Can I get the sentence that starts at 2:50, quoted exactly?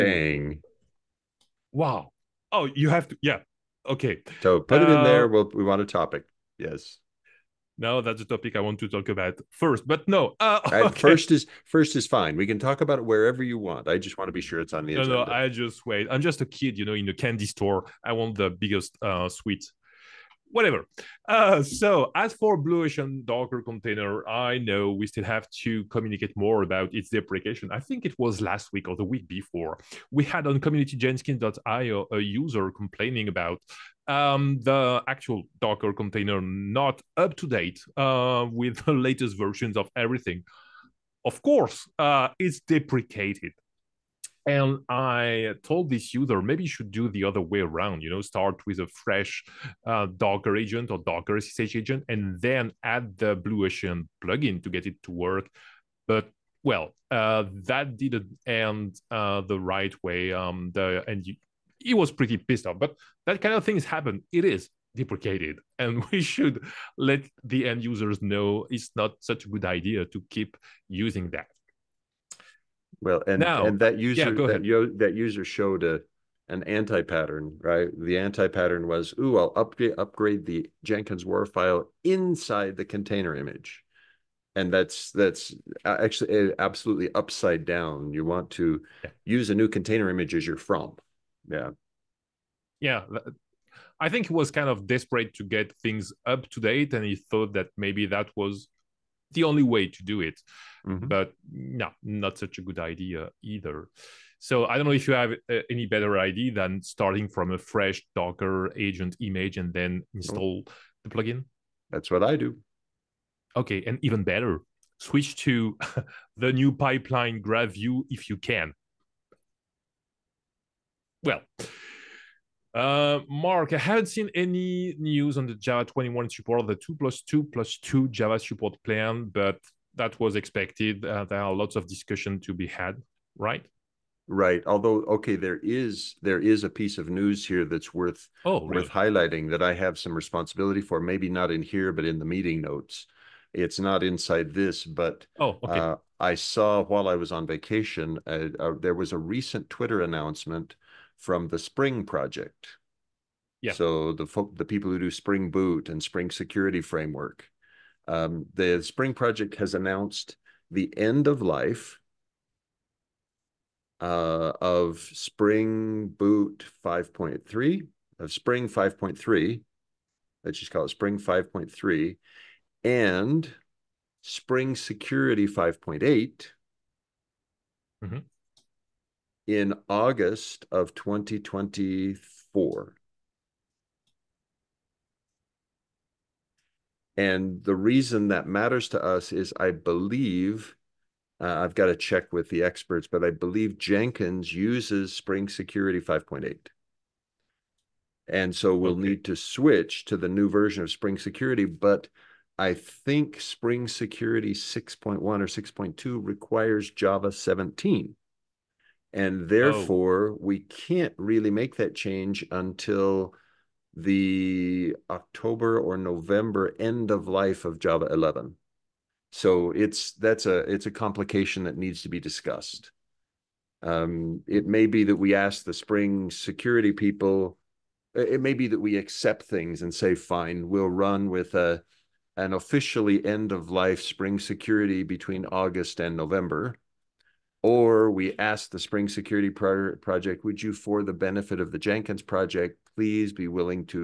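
Let's just call it Spring 5.3 and Spring Security 5.8.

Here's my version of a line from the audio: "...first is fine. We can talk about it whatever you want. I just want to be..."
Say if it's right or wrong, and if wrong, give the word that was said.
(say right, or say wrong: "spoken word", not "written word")
wrong: "wherever", not "whatever".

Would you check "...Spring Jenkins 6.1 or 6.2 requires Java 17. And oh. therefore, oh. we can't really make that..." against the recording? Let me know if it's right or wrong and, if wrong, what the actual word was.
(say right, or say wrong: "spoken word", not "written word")
wrong: "Security", not "Jenkins".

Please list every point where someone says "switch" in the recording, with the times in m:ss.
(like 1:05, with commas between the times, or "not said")
1:54, 3:19.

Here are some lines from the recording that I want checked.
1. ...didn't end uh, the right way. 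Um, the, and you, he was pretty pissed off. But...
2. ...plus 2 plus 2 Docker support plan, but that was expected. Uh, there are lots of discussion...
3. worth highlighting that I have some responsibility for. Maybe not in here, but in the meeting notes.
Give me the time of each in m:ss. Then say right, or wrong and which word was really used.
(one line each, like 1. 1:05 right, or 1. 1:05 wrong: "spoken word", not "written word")
1. 0:57 right
2. 2:06 wrong: "Java", not "Docker"
3. 2:18 right.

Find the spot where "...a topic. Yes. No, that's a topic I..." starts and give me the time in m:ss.
0:05.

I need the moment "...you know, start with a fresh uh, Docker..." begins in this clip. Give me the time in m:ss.
0:48.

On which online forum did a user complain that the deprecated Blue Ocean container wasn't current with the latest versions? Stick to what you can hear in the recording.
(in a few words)
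community.jenkins.io.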